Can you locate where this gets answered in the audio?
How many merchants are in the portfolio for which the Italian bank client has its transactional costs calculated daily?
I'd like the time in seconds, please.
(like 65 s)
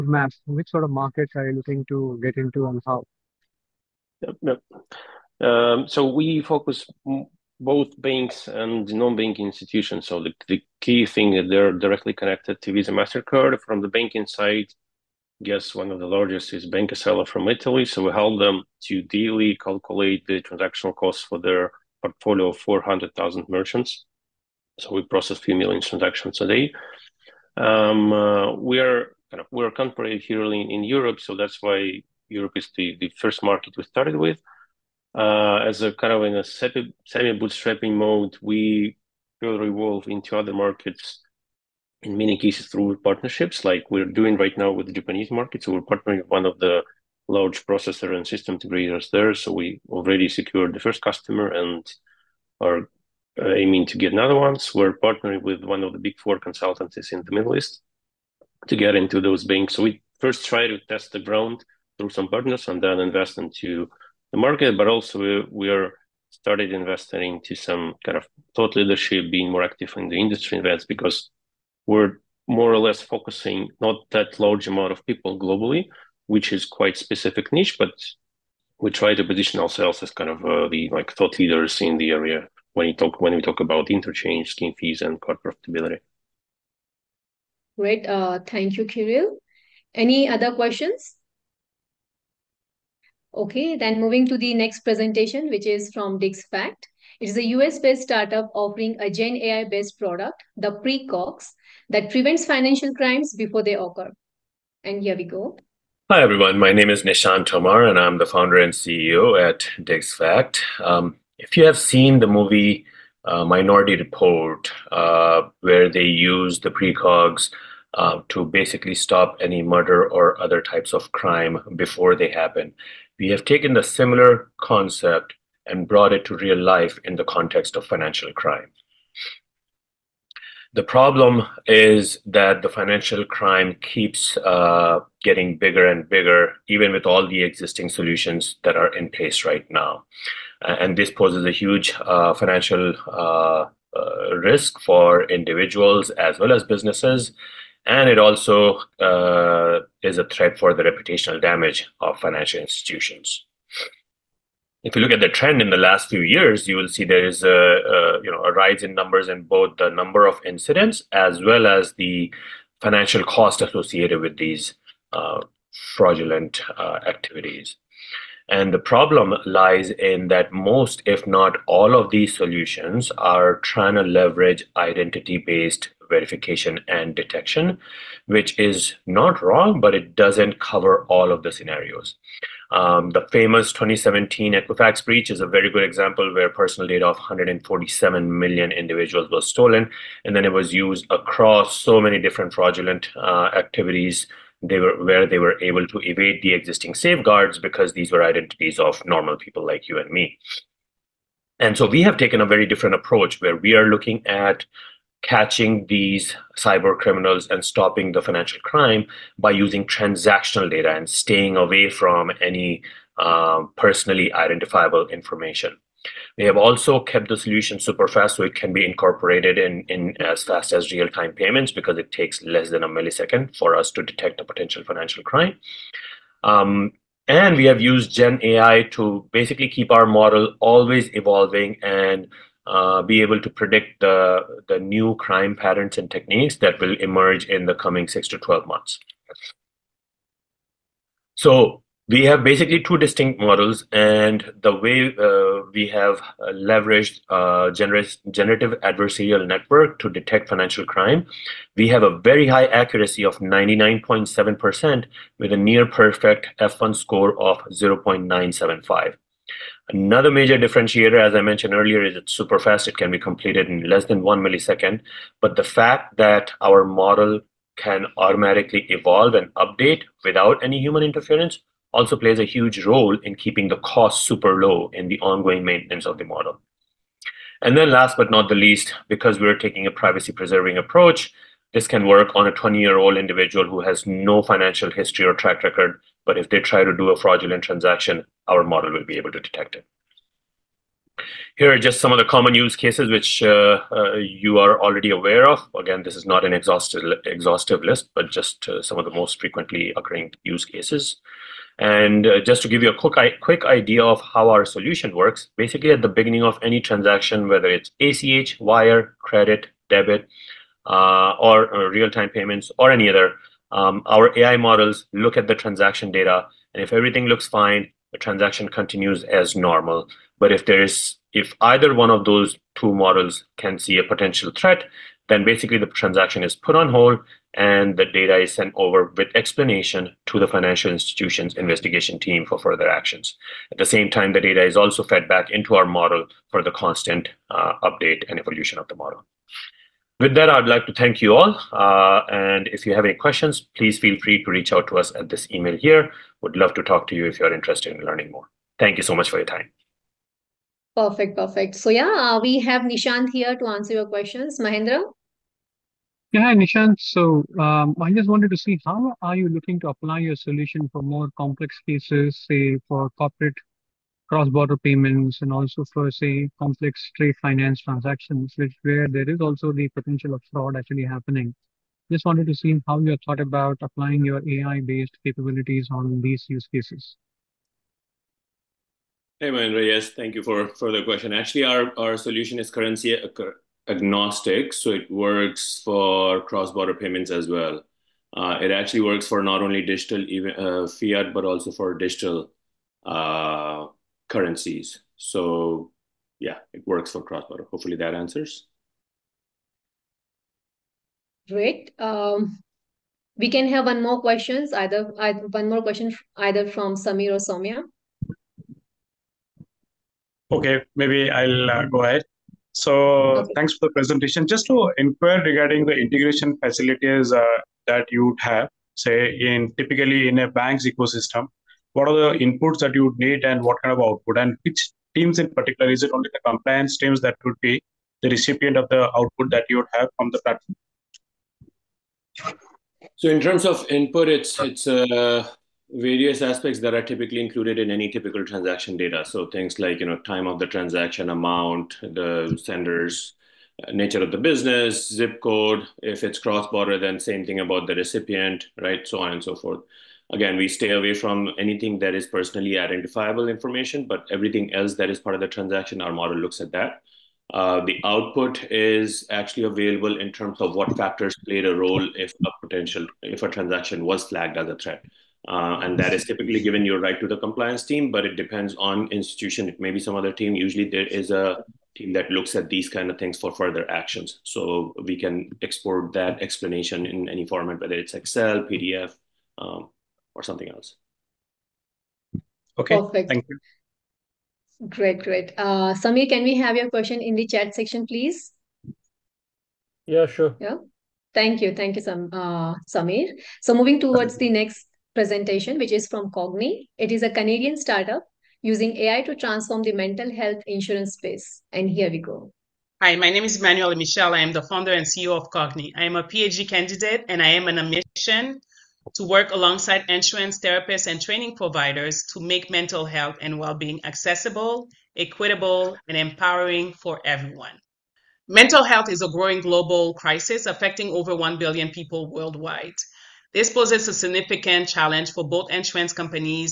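22 s.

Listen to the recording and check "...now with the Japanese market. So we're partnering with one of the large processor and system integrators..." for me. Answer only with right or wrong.
right.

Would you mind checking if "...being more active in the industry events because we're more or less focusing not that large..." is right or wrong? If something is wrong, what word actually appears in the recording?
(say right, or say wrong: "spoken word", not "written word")
right.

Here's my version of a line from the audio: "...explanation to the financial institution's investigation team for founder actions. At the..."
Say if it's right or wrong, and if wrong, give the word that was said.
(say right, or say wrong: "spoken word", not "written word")
wrong: "further", not "founder".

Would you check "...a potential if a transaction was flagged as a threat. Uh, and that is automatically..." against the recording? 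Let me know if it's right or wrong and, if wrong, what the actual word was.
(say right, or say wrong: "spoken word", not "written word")
wrong: "typically", not "automatically".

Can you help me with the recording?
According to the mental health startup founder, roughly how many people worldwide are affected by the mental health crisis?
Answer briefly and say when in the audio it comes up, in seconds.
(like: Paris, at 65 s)
over 1 billion, at 521 s.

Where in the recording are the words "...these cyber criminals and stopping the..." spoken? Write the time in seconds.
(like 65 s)
205 s.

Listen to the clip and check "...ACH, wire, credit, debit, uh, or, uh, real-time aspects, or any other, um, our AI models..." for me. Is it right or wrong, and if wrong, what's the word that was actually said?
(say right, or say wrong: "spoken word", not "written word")
wrong: "payments", not "aspects".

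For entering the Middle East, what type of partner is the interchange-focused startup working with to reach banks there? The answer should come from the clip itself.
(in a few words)
big four consultancies.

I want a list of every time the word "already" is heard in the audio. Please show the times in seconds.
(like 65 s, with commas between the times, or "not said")
49 s, 294 s.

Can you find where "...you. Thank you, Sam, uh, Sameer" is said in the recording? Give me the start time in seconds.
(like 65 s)
491 s.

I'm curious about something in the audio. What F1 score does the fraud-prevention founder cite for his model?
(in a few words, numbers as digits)
0.975.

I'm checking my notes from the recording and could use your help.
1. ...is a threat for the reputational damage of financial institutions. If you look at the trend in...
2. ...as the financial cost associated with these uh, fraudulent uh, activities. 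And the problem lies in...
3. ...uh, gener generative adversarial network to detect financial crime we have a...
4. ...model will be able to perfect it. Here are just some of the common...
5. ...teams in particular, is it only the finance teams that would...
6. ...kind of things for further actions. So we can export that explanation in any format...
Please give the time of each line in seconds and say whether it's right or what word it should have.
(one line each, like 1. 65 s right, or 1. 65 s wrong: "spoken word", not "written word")
1. 150 s right
2. 161 s right
3. 247 s right
4. 288 s wrong: "detect", not "perfect"
5. 425 s wrong: "compliance", not "finance"
6. 472 s right.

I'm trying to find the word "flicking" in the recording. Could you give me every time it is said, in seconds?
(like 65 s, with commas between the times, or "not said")
not said.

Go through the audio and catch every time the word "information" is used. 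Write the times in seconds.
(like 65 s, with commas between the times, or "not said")
215 s, 453 s.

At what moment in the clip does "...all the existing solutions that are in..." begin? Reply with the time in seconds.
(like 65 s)
137 s.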